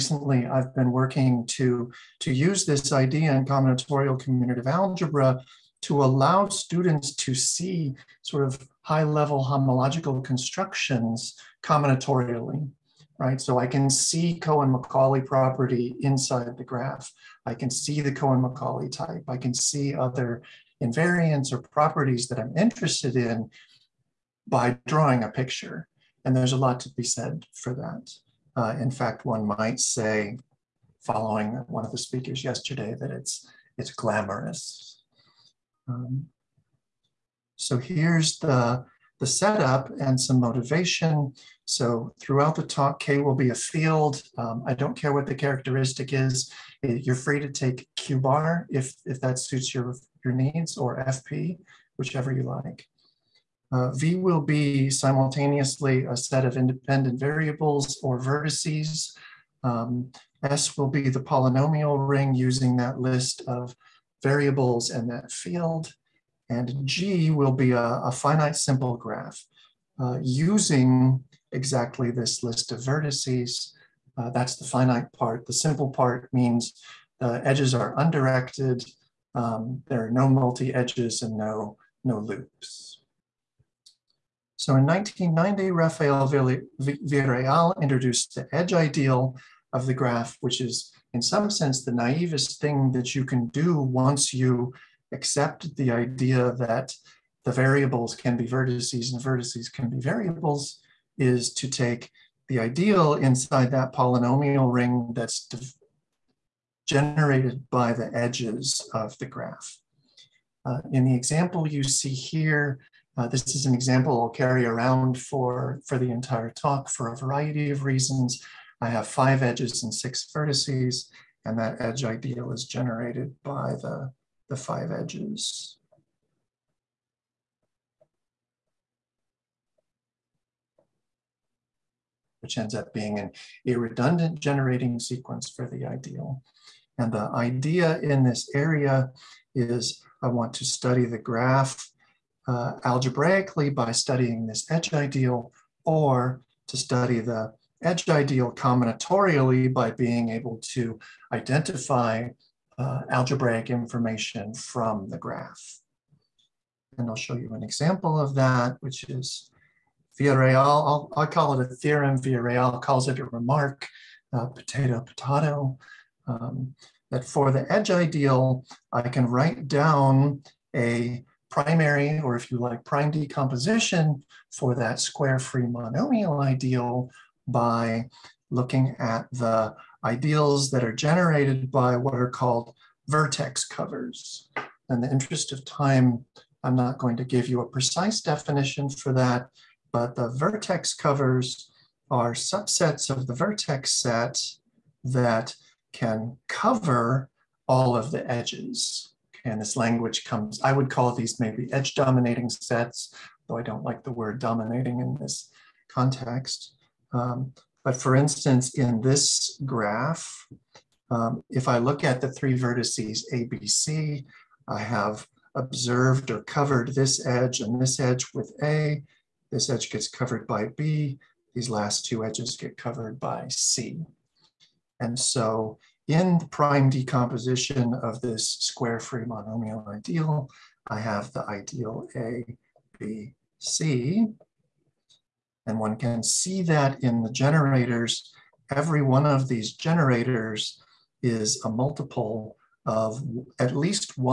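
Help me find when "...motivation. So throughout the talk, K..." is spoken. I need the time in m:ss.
0:40.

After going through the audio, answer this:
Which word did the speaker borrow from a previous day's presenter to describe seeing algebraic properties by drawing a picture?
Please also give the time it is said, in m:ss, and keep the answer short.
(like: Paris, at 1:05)
Glamorous, at 0:33.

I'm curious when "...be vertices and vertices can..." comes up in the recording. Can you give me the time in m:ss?
1:38.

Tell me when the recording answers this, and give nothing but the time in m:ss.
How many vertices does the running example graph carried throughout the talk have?
1:59.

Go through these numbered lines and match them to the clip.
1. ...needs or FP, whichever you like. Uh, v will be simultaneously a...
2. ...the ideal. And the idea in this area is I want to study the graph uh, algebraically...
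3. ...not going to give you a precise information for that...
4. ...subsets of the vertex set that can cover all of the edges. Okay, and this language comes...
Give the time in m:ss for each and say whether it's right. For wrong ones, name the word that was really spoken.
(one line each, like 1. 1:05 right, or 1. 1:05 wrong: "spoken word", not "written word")
1. 0:50 right
2. 2:15 right
3. 3:06 wrong: "definition", not "information"
4. 3:12 right.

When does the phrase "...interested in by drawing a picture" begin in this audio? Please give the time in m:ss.
0:22.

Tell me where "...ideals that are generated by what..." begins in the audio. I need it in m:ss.
3:00.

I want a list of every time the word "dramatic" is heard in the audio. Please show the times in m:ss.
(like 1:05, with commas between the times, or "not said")
not said.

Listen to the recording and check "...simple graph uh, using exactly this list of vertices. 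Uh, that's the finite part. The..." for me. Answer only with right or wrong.
right.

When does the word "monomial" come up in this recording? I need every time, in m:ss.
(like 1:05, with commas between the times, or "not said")
2:55, 3:49.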